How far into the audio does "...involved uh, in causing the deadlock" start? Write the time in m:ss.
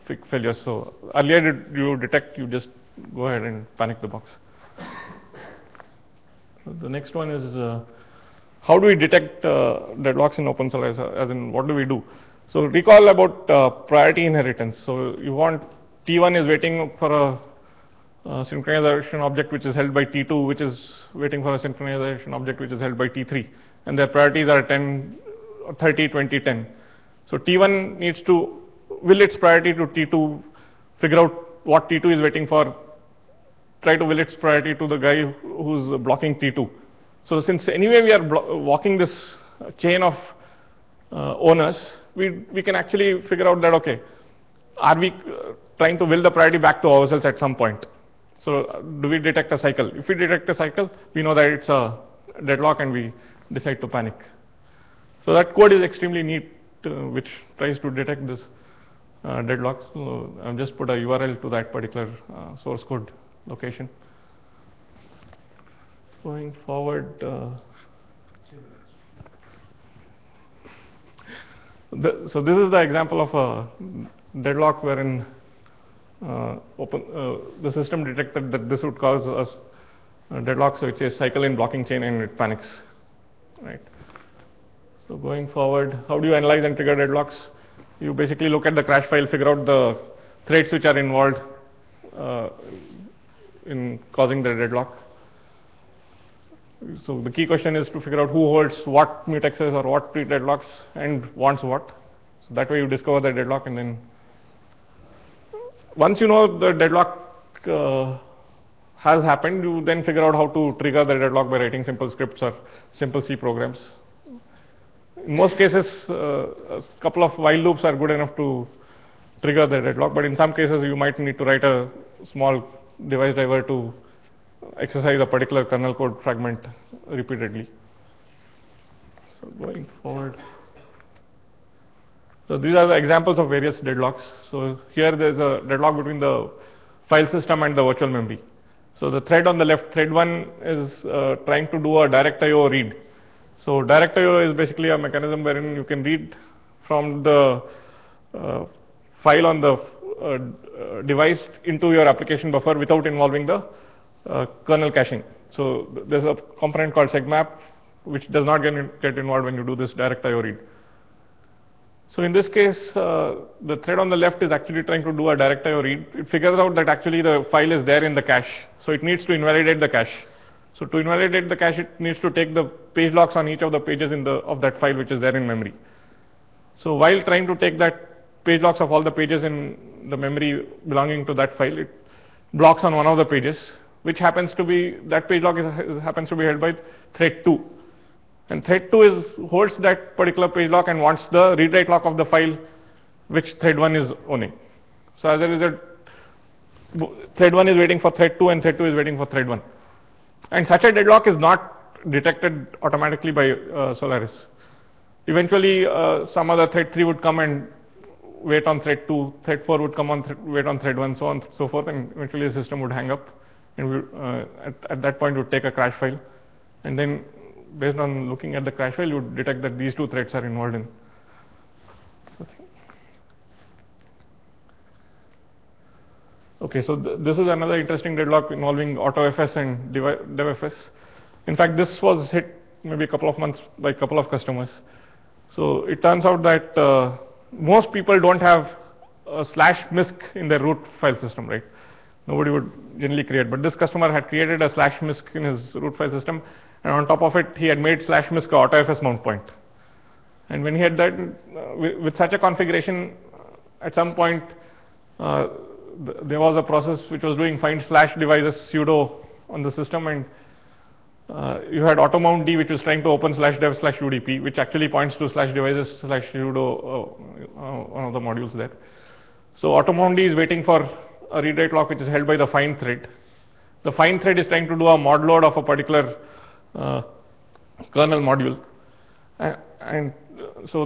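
1:30.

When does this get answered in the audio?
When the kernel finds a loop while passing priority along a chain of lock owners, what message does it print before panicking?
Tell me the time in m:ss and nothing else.
1:21.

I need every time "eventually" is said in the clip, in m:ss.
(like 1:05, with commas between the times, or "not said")
3:25, 3:32.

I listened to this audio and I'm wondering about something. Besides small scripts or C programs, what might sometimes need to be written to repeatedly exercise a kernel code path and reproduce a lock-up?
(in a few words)
small device driver.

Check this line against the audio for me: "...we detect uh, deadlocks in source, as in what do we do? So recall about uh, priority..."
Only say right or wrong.
right.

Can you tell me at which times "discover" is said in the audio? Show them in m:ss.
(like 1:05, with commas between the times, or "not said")
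1:42.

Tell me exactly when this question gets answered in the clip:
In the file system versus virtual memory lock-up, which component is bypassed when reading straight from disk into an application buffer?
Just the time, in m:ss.
2:37.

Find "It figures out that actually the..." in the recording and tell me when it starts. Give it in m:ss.
2:46.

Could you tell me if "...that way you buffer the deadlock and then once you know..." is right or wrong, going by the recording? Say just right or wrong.
wrong.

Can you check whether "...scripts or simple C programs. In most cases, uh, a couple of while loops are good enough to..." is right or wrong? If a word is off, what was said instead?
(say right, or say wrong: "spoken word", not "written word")
right.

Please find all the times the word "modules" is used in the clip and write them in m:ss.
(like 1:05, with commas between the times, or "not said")
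4:28, 4:38.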